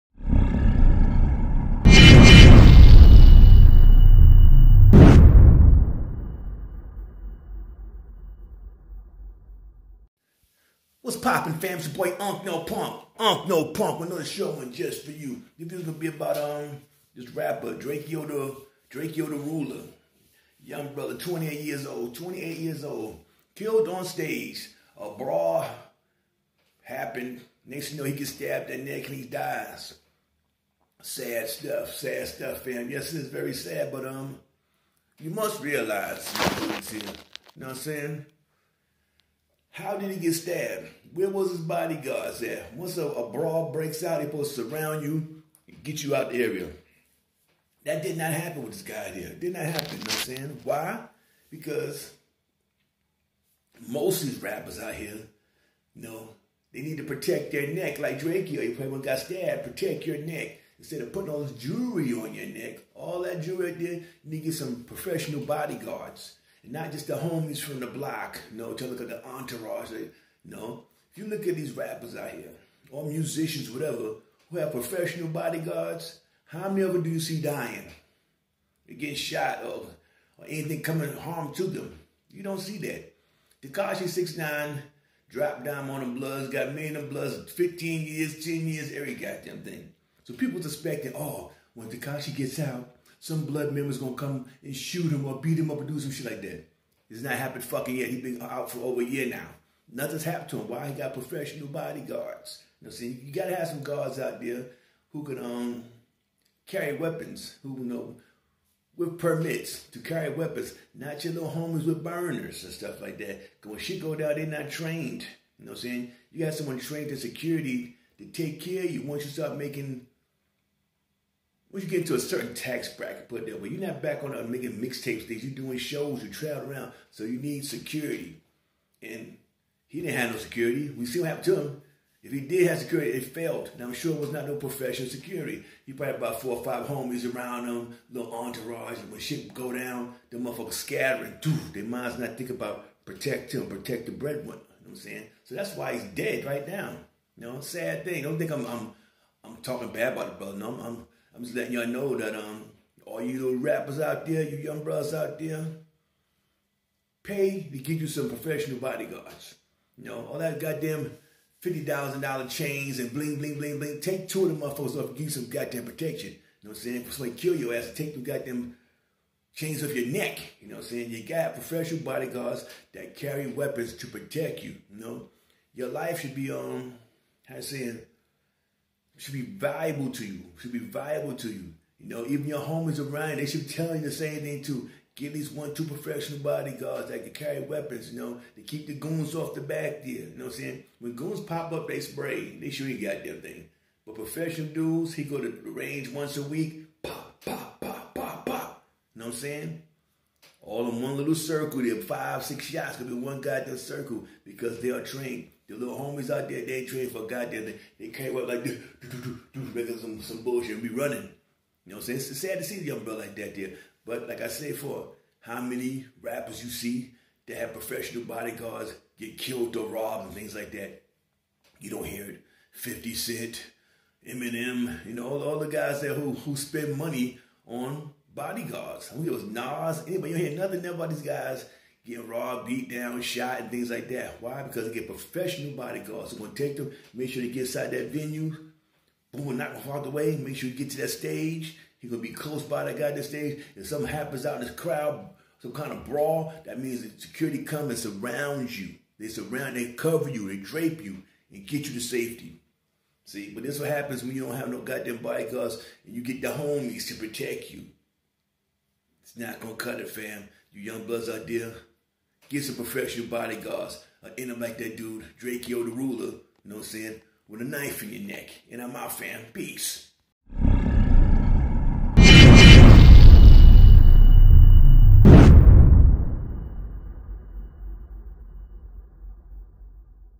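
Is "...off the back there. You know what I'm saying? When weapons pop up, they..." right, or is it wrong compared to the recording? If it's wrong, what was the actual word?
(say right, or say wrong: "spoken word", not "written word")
wrong: "goons", not "weapons".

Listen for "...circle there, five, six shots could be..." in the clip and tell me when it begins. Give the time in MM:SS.
03:21.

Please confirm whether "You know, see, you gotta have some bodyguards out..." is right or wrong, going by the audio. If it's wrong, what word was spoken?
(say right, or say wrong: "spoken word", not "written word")
wrong: "guards", not "bodyguards".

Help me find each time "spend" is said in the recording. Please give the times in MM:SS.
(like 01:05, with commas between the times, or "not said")
03:46.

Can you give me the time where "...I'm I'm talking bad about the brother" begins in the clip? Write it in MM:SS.
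02:28.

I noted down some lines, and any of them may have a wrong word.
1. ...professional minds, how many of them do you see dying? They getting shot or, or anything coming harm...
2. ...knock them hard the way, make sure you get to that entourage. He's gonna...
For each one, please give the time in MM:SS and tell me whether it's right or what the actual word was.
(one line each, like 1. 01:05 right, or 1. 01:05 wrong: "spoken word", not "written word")
1. 01:14 wrong: "bodyguards", not "minds"
2. 03:59 wrong: "stage", not "entourage".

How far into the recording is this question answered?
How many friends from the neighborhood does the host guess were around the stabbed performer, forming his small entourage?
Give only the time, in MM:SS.
02:16.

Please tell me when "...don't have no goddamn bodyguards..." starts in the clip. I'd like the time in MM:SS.
04:14.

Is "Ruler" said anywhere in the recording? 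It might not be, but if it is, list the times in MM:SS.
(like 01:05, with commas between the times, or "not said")
00:19, 04:25.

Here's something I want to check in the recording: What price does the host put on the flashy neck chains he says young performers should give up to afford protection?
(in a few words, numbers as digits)
$50,000.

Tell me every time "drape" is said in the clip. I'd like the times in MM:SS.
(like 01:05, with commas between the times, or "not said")
04:10.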